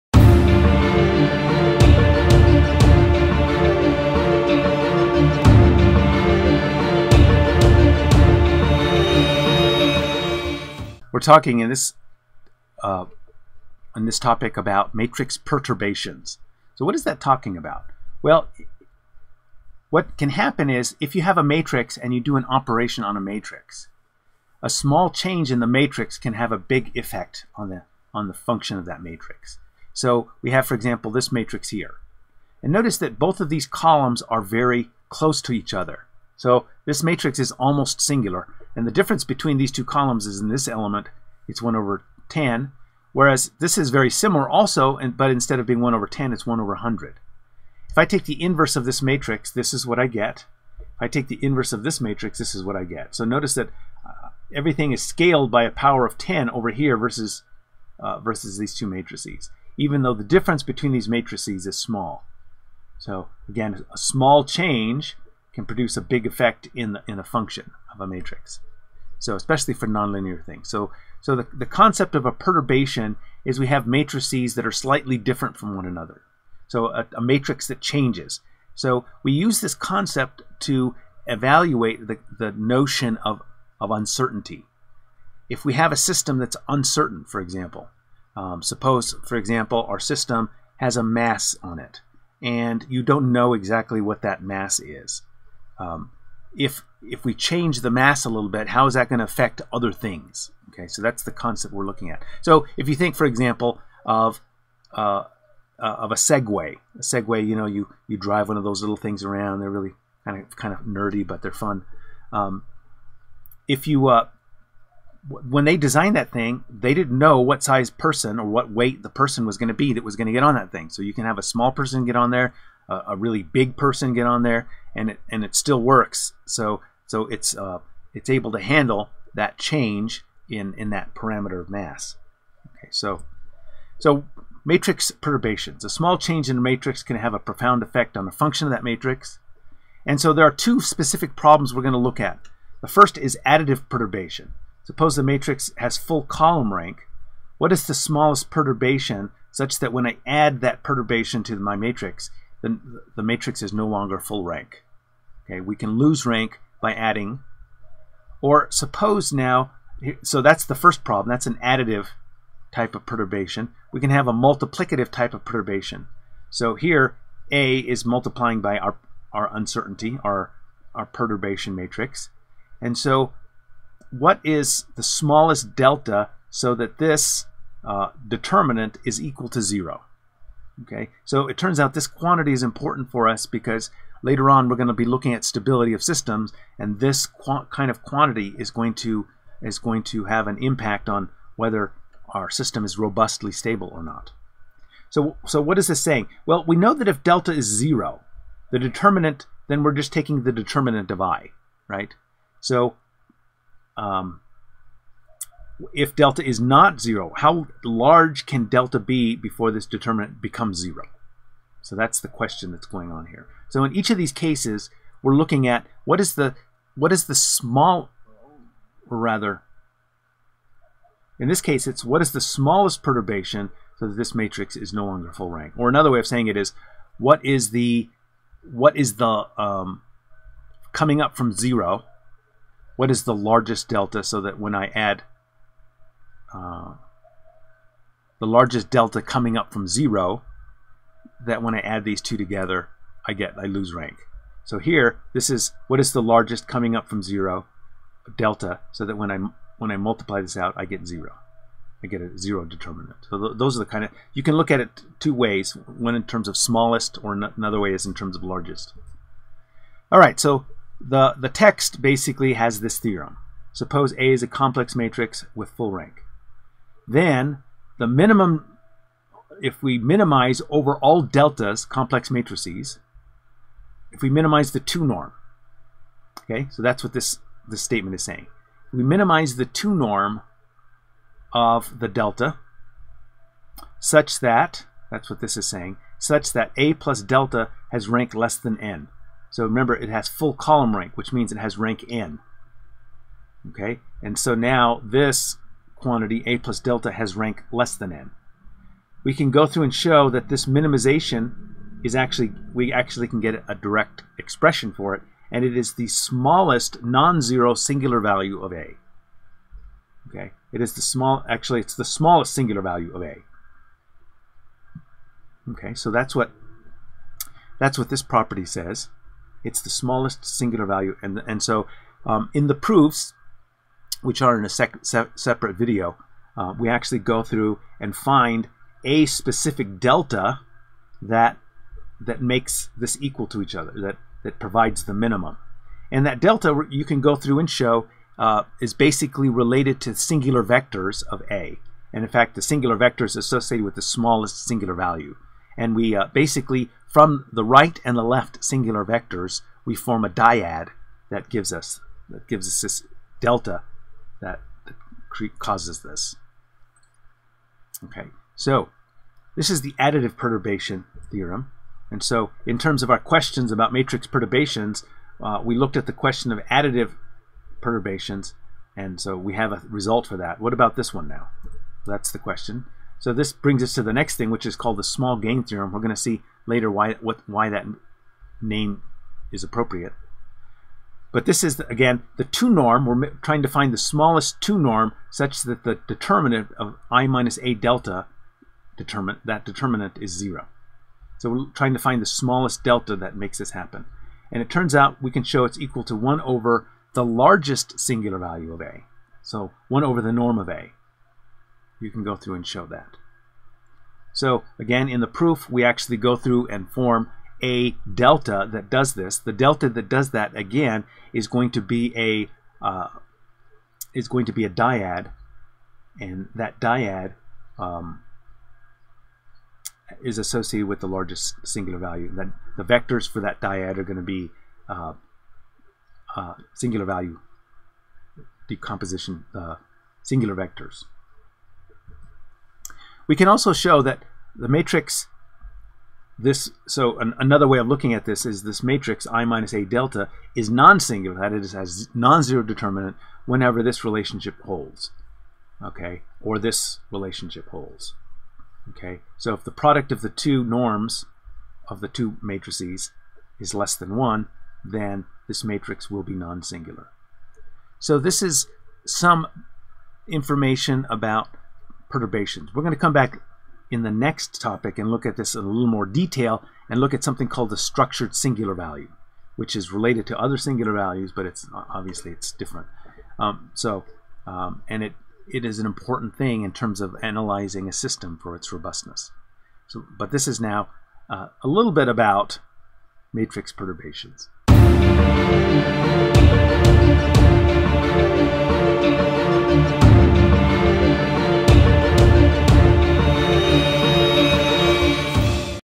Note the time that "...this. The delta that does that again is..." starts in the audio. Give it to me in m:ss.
6:49.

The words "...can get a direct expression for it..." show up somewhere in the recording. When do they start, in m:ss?
5:03.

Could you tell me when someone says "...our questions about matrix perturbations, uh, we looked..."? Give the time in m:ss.
6:03.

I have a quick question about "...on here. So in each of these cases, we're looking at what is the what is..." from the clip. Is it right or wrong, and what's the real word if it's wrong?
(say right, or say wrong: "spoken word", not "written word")
right.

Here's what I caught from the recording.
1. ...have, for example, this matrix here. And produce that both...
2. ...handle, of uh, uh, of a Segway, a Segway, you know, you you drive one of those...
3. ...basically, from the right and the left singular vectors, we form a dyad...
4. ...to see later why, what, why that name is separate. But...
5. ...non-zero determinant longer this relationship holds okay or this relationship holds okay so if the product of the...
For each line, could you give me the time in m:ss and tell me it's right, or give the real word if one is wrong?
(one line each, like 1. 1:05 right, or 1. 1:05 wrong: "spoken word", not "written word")
1. 0:30 wrong: "notice", not "produce"
2. 1:43 wrong: "example", not "handle"
3. 5:46 right
4. 6:16 wrong: "appropriate", not "separate"
5. 7:22 wrong: "whenever", not "longer".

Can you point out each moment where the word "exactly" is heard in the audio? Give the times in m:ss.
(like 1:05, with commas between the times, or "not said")
1:33.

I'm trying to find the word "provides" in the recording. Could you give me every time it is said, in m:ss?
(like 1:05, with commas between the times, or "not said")
5:34.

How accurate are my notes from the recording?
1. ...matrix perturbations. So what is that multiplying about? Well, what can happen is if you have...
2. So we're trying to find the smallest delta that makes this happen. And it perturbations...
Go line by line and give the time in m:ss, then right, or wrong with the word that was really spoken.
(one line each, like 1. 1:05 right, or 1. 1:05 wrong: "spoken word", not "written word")
1. 0:14 wrong: "talking", not "multiplying"
2. 6:31 wrong: "turns", not "perturbations".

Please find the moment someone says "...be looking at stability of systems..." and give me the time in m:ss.
3:04.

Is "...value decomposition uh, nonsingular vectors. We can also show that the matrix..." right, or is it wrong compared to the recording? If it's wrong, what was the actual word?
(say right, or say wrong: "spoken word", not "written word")
wrong: "singular", not "nonsingular".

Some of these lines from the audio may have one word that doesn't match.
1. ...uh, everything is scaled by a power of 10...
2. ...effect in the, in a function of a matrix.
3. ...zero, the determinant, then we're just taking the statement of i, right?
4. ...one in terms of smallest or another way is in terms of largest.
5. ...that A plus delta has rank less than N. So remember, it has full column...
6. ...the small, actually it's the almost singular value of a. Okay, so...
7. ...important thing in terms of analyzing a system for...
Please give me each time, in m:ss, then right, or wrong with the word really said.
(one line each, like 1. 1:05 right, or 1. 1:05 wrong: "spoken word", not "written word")
1. 0:54 right
2. 1:06 right
3. 3:17 wrong: "determinant", not "statement"
4. 4:15 right
5. 4:46 right
6. 5:10 wrong: "smallest", not "almost"
7. 7:55 right.